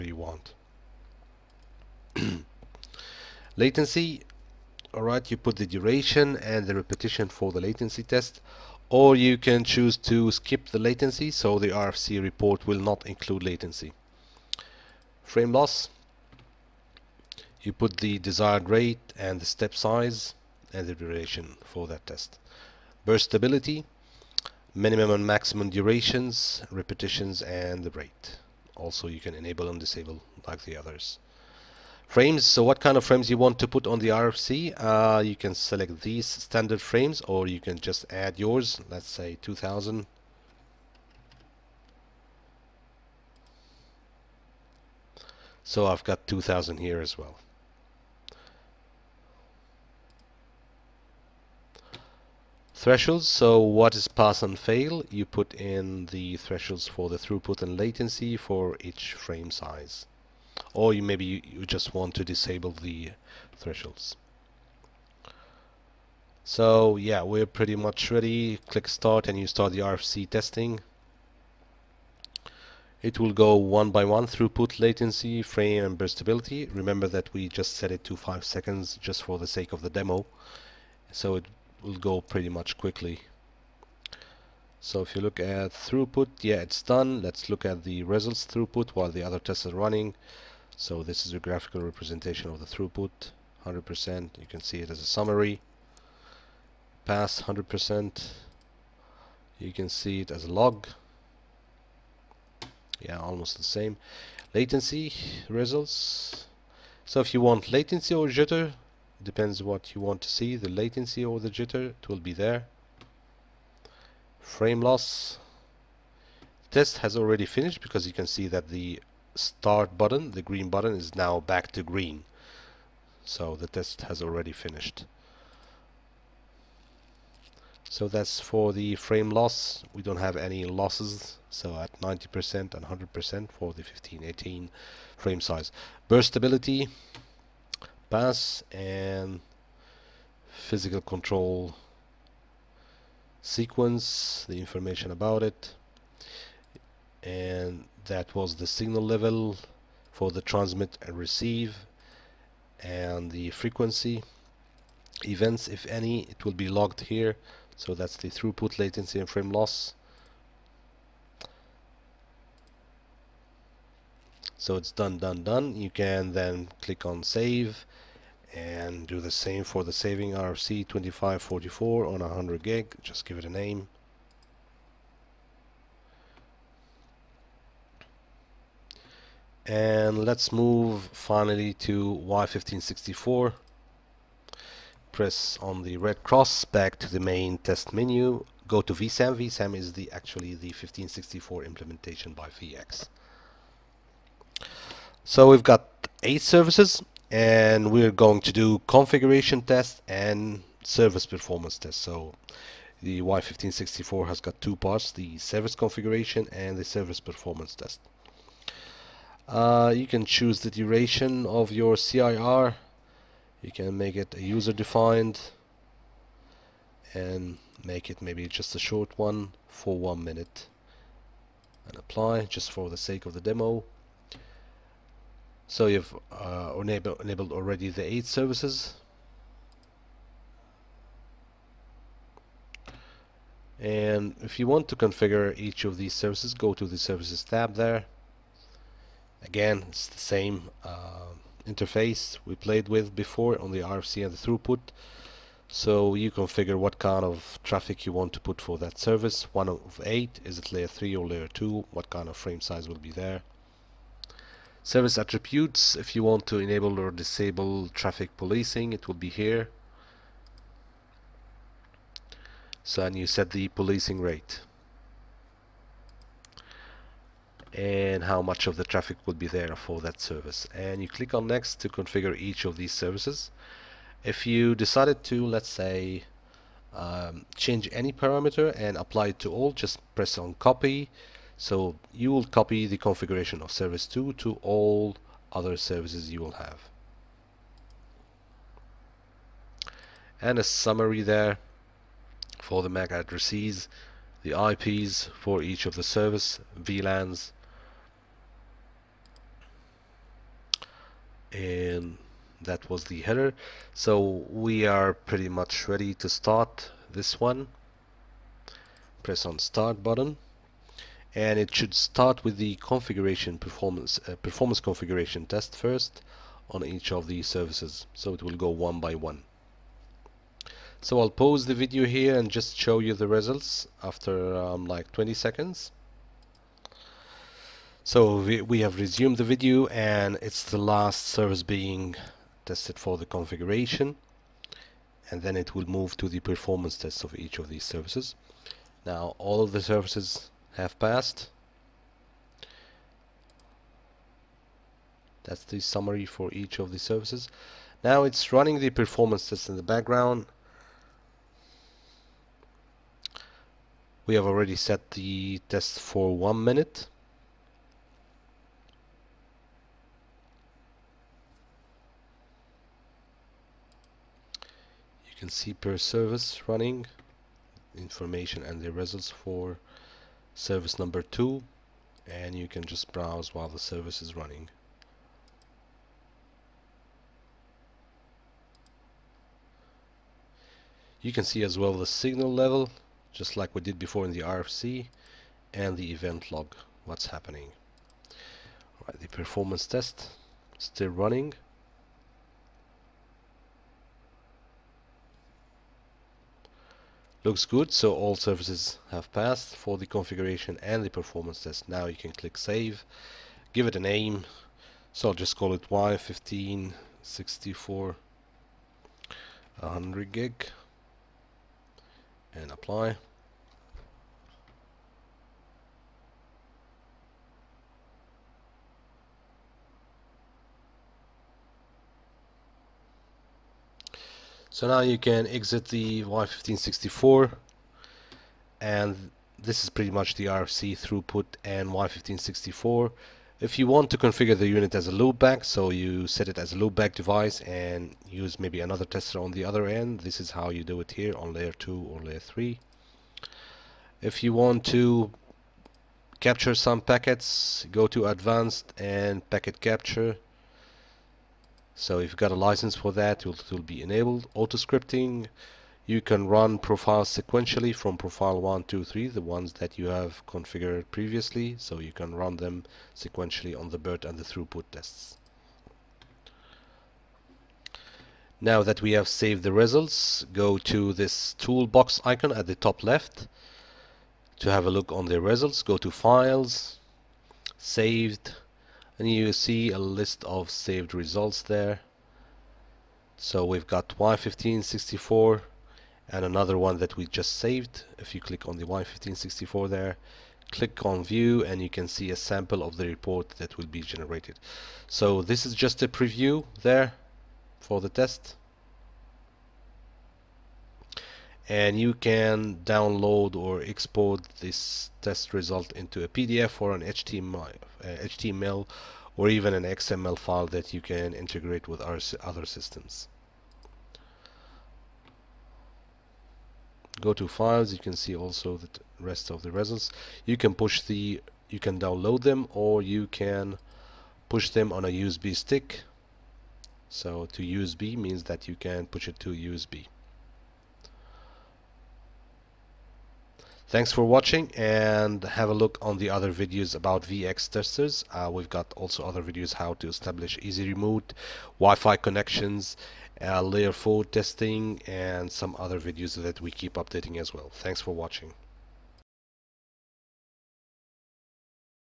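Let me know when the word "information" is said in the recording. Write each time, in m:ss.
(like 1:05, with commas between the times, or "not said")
2:24, 6:07.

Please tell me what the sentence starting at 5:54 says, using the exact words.
We have already set the test for one minute.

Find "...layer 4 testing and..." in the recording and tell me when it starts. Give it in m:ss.
9:03.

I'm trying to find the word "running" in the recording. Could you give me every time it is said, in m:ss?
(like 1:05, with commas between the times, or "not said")
1:29, 5:48, 6:06, 6:14, 6:31.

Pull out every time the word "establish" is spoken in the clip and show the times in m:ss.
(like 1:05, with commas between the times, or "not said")
9:00.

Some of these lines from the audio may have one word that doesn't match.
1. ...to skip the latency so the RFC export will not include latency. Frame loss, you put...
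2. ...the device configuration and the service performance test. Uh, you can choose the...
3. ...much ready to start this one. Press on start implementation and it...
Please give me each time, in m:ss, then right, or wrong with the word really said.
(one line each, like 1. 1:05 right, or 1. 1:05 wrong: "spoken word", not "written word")
1. 0:09 wrong: "report", not "export"
2. 3:25 wrong: "service", not "device"
3. 5:05 wrong: "button", not "implementation".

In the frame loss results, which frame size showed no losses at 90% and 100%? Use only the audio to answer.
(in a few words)
1518.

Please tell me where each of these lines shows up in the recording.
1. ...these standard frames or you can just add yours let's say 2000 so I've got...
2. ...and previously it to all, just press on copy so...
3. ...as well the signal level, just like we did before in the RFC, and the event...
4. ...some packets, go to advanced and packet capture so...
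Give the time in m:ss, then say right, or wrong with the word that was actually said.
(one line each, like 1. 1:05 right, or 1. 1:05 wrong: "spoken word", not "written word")
1. 0:36 right
2. 4:38 wrong: "apply", not "previously"
3. 6:21 right
4. 7:26 right.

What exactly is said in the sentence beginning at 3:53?
And if you want to configure each of these services, go to the services tab there.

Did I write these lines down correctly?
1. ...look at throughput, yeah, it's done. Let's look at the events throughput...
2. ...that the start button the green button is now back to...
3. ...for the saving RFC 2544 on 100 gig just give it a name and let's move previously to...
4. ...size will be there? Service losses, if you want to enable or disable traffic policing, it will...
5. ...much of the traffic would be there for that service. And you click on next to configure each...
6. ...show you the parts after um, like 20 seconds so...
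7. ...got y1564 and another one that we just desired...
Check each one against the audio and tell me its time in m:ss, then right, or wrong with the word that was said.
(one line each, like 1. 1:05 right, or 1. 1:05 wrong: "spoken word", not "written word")
1. 1:25 wrong: "results", not "events"
2. 1:58 right
3. 2:49 wrong: "finally", not "previously"
4. 4:12 wrong: "attributes", not "losses"
5. 4:28 right
6. 5:22 wrong: "results", not "parts"
7. 8:03 wrong: "saved", not "desired".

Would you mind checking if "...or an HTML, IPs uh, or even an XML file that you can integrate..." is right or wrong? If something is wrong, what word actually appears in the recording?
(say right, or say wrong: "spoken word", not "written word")
wrong: "HTML", not "IPs".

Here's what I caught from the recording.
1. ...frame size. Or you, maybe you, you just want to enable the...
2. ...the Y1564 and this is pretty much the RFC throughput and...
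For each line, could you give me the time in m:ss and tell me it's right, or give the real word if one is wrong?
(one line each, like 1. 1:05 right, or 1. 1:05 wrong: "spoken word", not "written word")
1. 0:59 wrong: "disable", not "enable"
2. 7:05 right.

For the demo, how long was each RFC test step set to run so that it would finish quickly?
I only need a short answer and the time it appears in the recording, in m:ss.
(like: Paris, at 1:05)
5 seconds, at 1:18.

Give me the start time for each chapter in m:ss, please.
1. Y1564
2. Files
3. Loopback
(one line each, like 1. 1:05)
1. 3:01
2. 7:46
3. 7:13.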